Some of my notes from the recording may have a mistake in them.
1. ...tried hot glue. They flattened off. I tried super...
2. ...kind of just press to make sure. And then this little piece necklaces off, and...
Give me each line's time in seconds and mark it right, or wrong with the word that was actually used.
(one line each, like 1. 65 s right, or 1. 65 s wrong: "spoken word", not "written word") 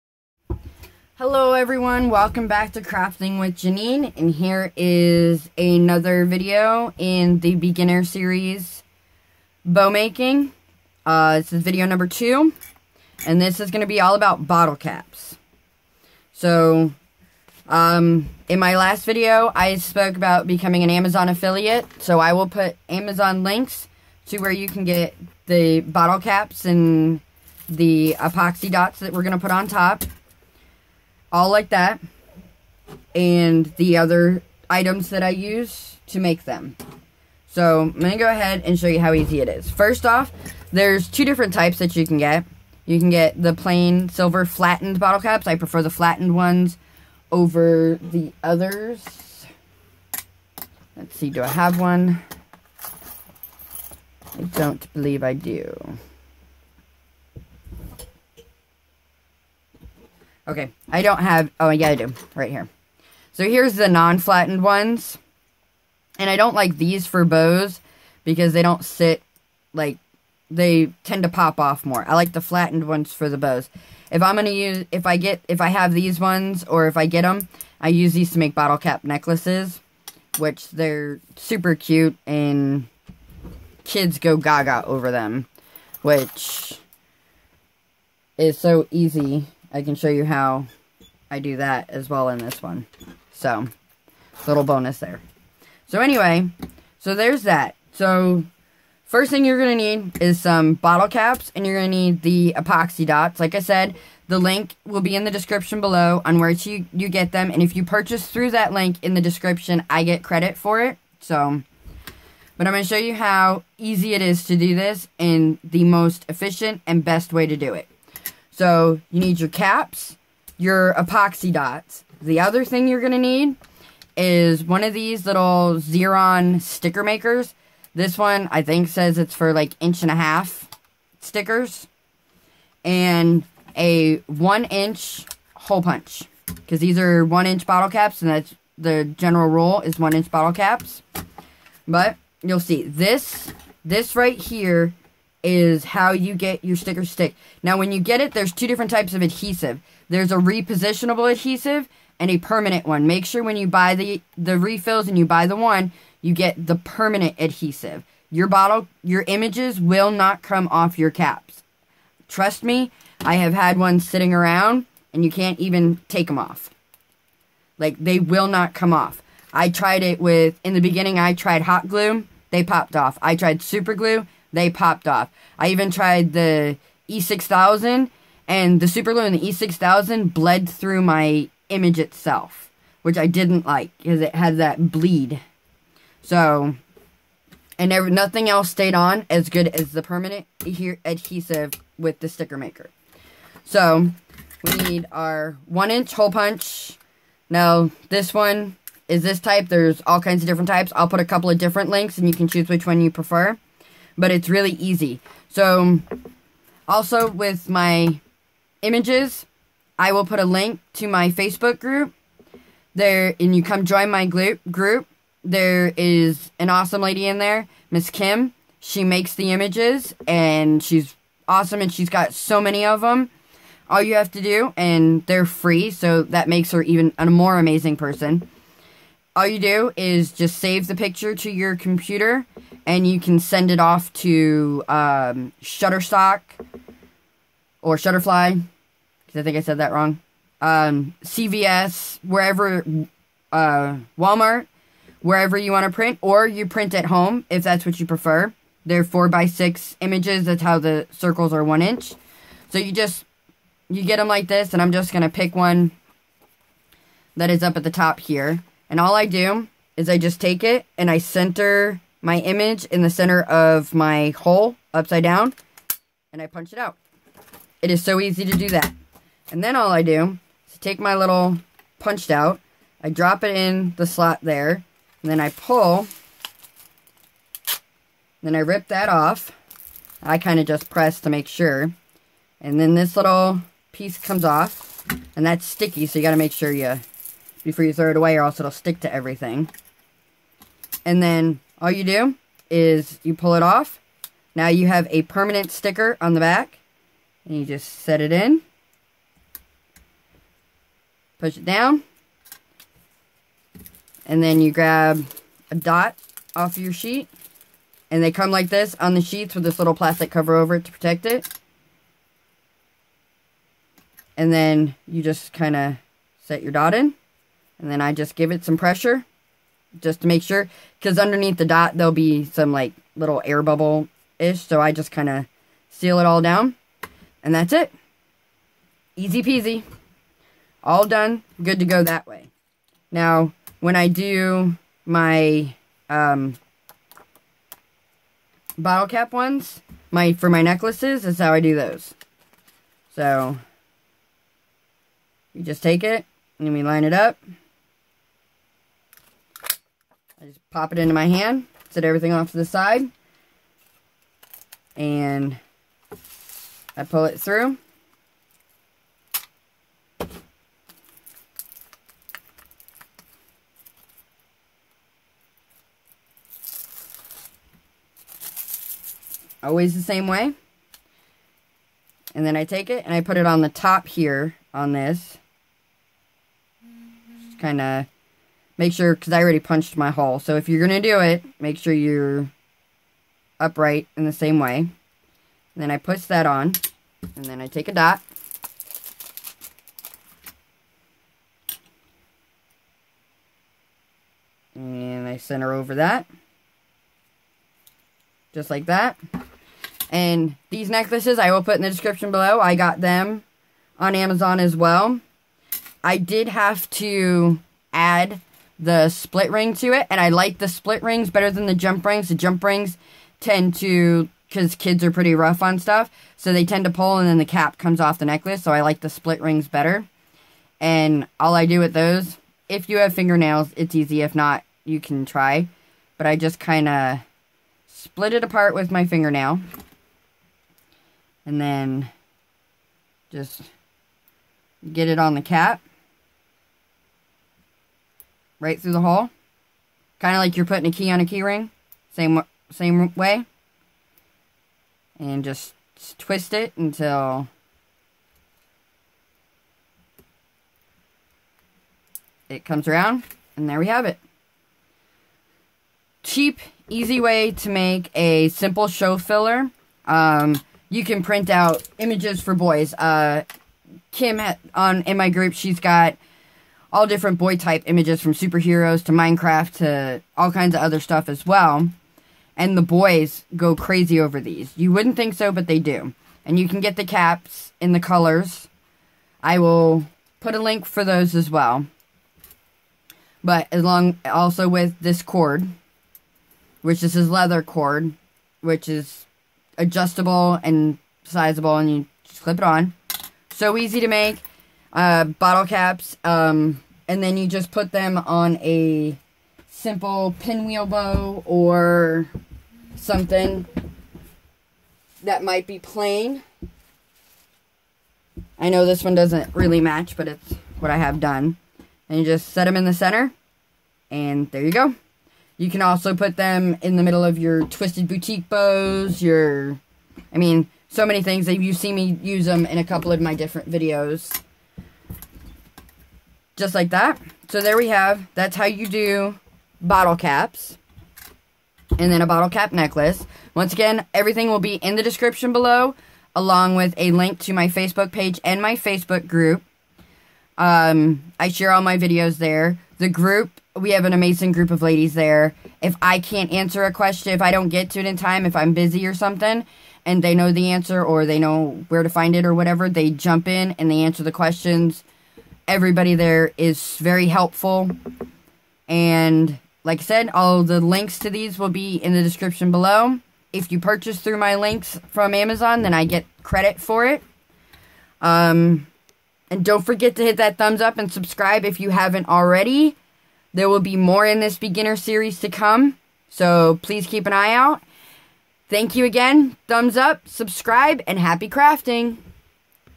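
1. 171 s wrong: "popped", not "flattened"
2. 280 s wrong: "comes", not "necklaces".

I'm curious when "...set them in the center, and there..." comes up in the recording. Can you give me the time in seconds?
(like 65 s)
512 s.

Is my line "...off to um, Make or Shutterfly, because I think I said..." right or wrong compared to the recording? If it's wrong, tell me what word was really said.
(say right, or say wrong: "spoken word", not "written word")
wrong: "Shutterstock", not "Make".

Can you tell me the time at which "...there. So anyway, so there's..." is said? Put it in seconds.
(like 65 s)
94 s.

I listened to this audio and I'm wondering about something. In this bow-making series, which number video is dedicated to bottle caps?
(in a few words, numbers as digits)
2.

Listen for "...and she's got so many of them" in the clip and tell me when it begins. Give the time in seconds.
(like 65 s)
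221 s.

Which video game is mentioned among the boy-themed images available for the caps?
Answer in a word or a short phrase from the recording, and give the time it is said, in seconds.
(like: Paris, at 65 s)
Minecraft, at 469 s.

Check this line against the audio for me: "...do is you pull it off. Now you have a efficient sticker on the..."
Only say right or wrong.
wrong.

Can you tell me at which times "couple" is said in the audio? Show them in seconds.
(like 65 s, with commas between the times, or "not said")
201 s, 522 s.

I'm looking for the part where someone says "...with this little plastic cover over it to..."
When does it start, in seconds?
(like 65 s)
309 s.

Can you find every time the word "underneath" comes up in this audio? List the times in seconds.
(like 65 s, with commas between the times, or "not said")
321 s.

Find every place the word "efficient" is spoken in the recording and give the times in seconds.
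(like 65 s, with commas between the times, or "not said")
116 s.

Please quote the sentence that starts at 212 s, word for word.
There, and you come join my group.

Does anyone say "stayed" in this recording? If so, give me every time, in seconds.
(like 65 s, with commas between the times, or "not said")
188 s.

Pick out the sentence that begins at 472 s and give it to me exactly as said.
And the boys go crazy over these.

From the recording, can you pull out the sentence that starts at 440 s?
Kind of like you're putting a key on a key ring.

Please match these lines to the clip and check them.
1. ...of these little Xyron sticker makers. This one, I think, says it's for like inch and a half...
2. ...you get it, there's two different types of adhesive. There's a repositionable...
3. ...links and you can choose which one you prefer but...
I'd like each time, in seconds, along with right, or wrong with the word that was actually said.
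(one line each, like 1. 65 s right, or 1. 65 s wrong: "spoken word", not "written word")
1. 124 s right
2. 147 s right
3. 201 s right.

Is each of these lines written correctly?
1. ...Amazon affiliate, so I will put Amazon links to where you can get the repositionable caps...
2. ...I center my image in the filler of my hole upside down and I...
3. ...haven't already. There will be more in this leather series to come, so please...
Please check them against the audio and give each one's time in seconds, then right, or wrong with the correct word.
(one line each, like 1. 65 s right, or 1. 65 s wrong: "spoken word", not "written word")
1. 20 s wrong: "bottle", not "repositionable"
2. 261 s wrong: "center", not "filler"
3. 571 s wrong: "beginner", not "leather".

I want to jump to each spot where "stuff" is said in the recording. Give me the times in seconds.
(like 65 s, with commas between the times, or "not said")
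415 s, 470 s.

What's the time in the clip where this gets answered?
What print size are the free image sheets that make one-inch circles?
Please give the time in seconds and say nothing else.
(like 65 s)
249 s.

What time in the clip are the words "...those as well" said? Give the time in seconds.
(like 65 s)
481 s.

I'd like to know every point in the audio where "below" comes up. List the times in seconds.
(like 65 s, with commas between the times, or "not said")
105 s, 402 s, 535 s, 562 s.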